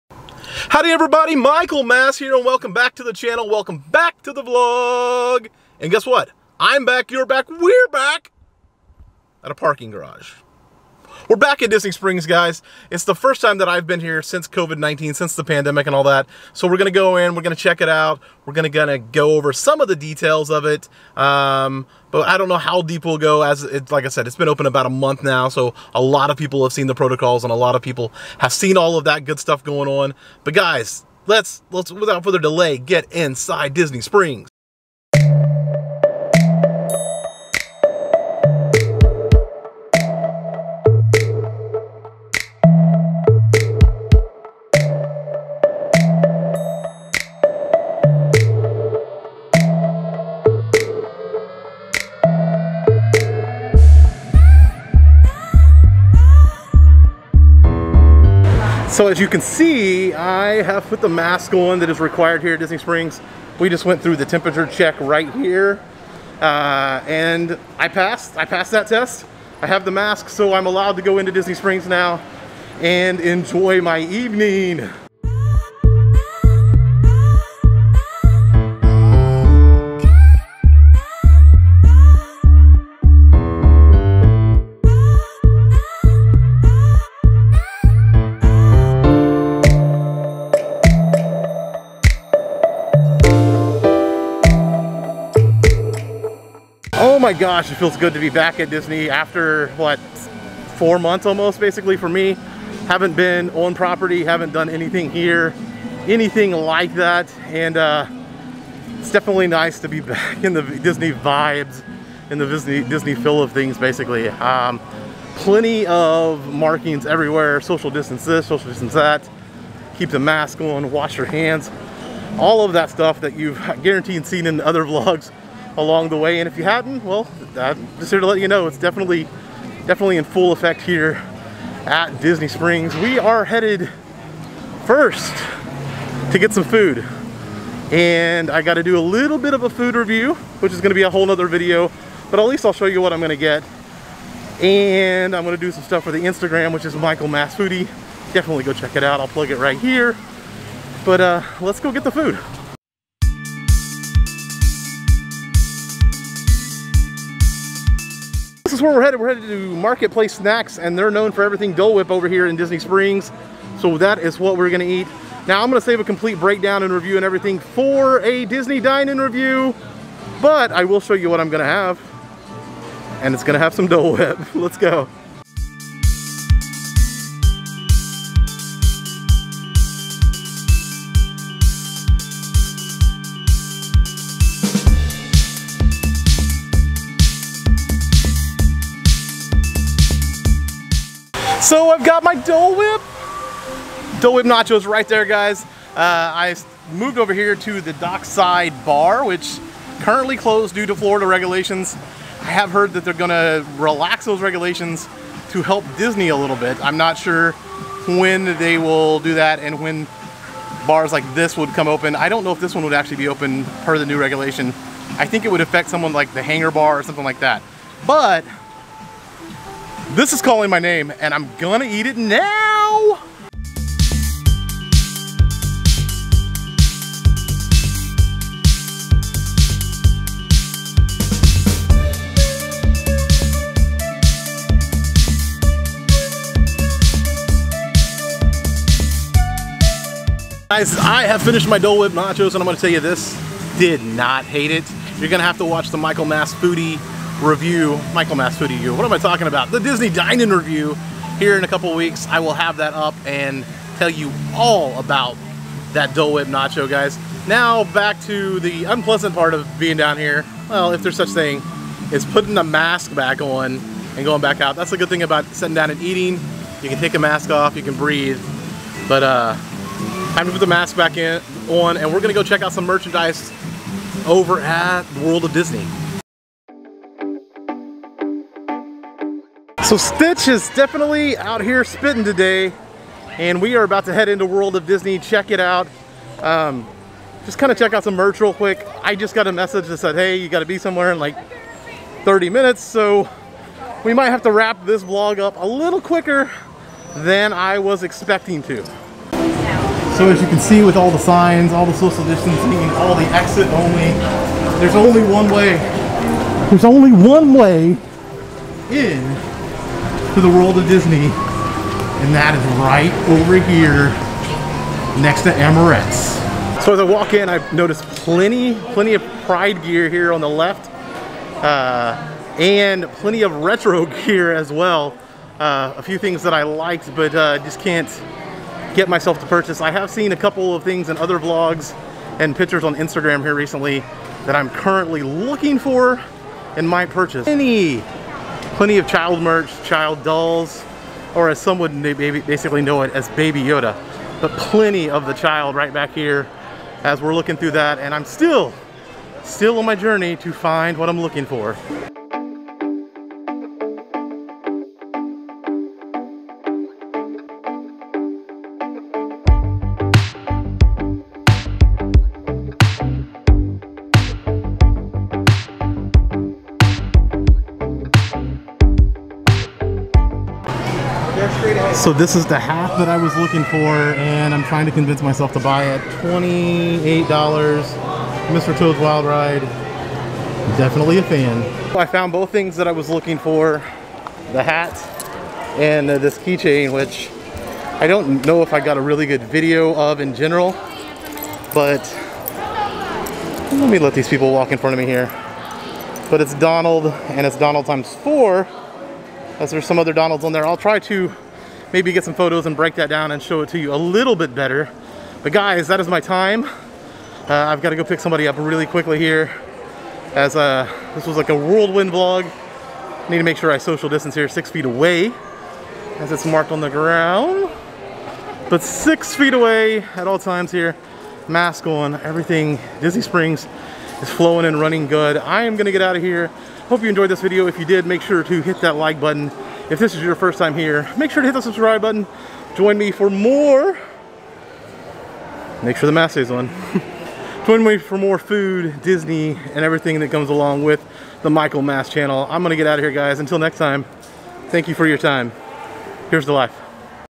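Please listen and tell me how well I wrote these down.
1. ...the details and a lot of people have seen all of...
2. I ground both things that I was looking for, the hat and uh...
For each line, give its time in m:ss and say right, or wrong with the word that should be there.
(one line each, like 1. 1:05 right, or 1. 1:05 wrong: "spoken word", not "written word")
1. 0:26 wrong: "protocols", not "details"
2. 6:21 wrong: "found", not "ground".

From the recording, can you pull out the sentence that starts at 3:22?
I have heard that they're gonna relax those regulations to help Disney a little bit.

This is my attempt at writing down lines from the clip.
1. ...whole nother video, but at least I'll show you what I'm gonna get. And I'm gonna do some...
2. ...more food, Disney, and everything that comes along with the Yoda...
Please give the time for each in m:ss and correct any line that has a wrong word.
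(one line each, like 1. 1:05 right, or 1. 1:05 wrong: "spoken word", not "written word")
1. 2:21 right
2. 7:18 wrong: "Michael", not "Yoda".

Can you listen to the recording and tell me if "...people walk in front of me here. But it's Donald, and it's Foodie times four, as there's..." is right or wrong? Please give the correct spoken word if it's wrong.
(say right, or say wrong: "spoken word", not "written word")
wrong: "Donald", not "Foodie".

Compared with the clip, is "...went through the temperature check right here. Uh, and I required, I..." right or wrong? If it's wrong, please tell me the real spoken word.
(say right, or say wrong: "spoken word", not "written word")
wrong: "passed", not "required".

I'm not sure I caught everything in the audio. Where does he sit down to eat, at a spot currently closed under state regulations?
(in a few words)
Dockside Bar.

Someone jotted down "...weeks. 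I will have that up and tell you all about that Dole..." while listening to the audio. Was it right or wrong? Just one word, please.
right.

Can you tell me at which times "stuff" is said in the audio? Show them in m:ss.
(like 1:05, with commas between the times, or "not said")
0:29, 2:02, 2:25.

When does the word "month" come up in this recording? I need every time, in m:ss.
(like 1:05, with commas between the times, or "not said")
0:24, 1:40.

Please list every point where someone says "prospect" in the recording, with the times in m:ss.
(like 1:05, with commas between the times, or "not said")
not said.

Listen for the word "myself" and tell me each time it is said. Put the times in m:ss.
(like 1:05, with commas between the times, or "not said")
5:29, 6:15.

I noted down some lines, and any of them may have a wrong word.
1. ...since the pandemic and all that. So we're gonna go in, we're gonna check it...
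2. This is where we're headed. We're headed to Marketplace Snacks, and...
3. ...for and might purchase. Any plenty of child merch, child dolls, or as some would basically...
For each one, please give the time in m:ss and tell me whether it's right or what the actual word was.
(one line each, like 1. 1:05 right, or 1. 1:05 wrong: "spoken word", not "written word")
1. 0:15 right
2. 2:38 right
3. 5:35 right.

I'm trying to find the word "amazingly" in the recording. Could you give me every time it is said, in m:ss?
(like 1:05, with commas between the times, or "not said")
not said.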